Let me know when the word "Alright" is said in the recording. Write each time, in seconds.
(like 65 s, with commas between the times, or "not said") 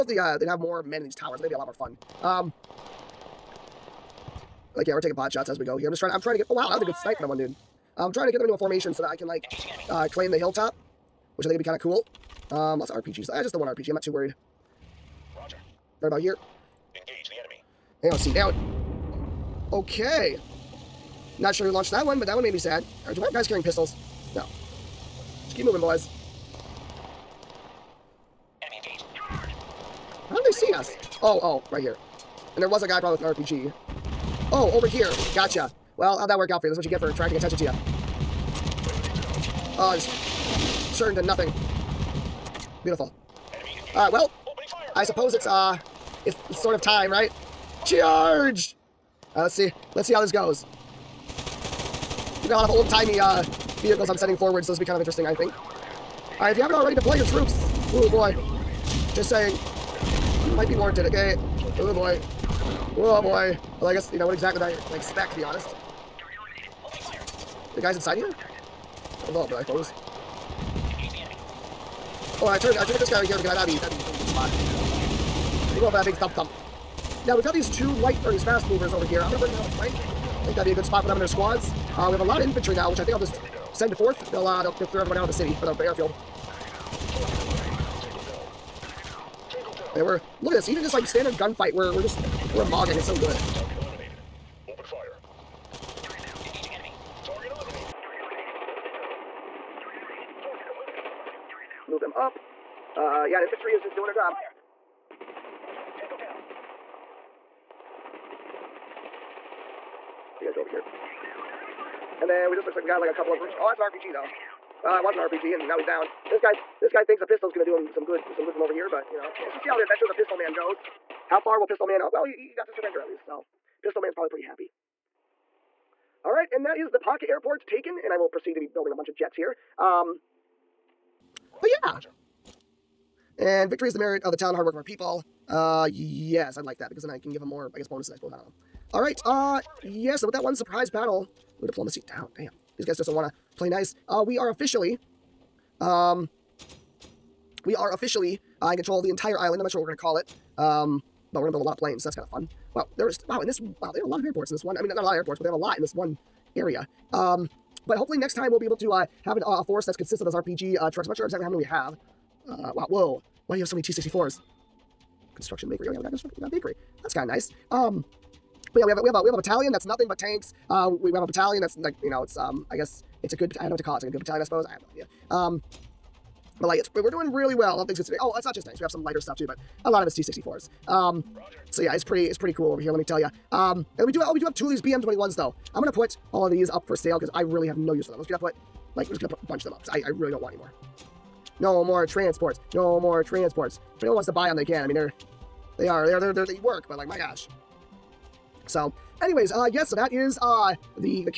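43 s, 56 s.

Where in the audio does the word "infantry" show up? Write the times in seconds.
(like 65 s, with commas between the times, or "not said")
82 s, 103 s.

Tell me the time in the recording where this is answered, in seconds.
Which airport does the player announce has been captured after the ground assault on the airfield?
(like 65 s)
126 s.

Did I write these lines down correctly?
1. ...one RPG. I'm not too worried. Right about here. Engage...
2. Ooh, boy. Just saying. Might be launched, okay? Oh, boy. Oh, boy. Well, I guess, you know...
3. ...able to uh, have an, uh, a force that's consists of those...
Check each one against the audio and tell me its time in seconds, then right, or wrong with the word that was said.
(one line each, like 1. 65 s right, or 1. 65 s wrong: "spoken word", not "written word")
1. 13 s right
2. 57 s wrong: "warranted", not "launched"
3. 158 s right.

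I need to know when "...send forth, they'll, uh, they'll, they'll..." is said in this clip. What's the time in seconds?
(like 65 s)
83 s.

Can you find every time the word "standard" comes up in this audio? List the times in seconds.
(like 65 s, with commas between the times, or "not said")
91 s.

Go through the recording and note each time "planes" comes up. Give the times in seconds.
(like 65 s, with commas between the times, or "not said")
151 s.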